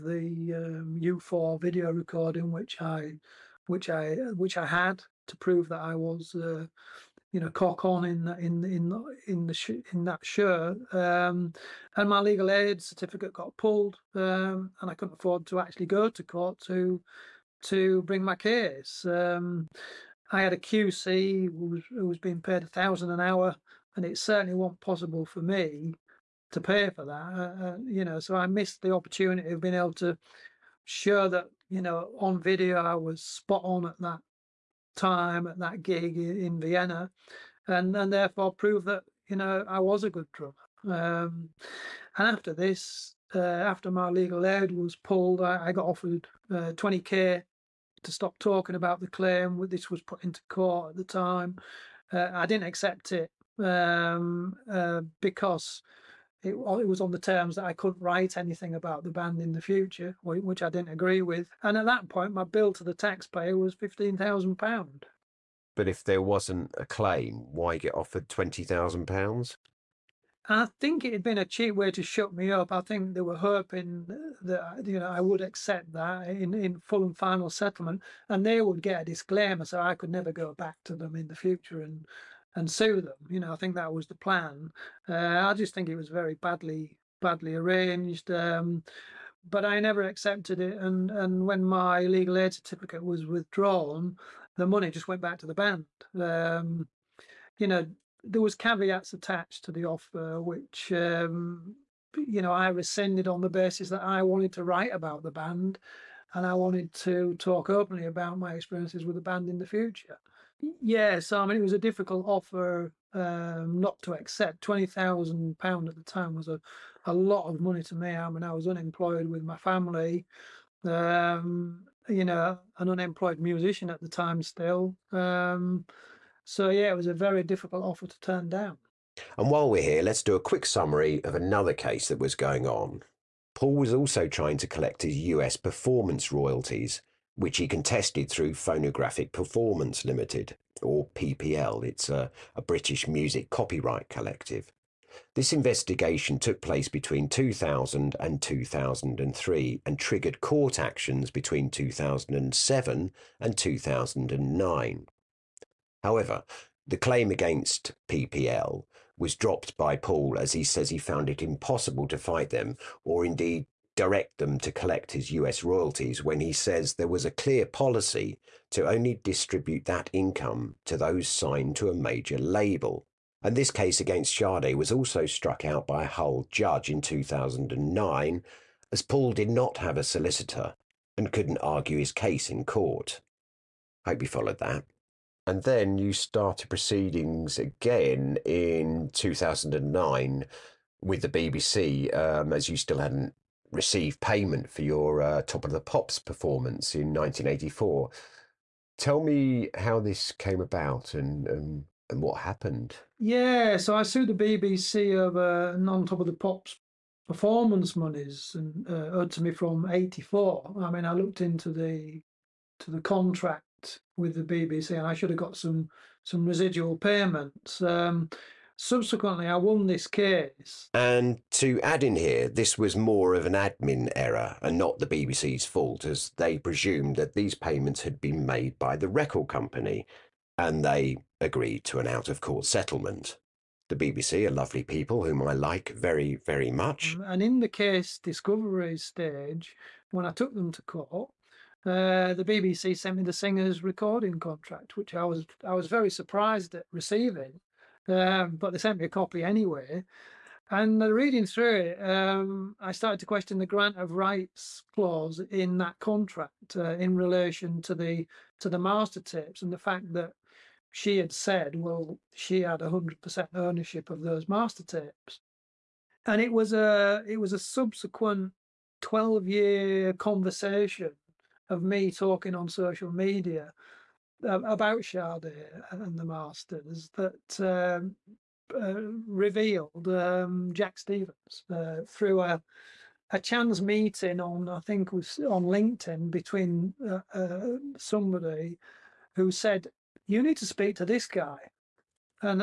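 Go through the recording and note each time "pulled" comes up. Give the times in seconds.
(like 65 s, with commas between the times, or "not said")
13 s, 44 s.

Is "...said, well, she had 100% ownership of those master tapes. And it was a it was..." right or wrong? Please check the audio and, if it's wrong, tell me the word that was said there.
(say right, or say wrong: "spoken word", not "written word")
right.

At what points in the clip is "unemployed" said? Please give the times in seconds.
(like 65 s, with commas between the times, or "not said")
118 s, 122 s.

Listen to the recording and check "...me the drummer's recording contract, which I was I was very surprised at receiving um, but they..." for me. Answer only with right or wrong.
wrong.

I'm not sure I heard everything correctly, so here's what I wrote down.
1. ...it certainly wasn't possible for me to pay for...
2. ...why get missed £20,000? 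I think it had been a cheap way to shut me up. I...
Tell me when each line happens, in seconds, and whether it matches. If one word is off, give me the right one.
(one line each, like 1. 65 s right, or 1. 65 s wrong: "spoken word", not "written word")
1. 24 s right
2. 67 s wrong: "offered", not "missed".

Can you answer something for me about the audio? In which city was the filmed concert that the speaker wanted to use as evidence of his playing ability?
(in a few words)
Vienna.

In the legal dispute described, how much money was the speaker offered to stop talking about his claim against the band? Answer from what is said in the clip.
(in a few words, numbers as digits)
£20,000.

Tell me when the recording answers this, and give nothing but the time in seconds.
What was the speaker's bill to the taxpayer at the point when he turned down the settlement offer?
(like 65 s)
63 s.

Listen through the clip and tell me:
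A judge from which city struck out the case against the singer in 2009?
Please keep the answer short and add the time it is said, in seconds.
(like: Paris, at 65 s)
Hull, at 176 s.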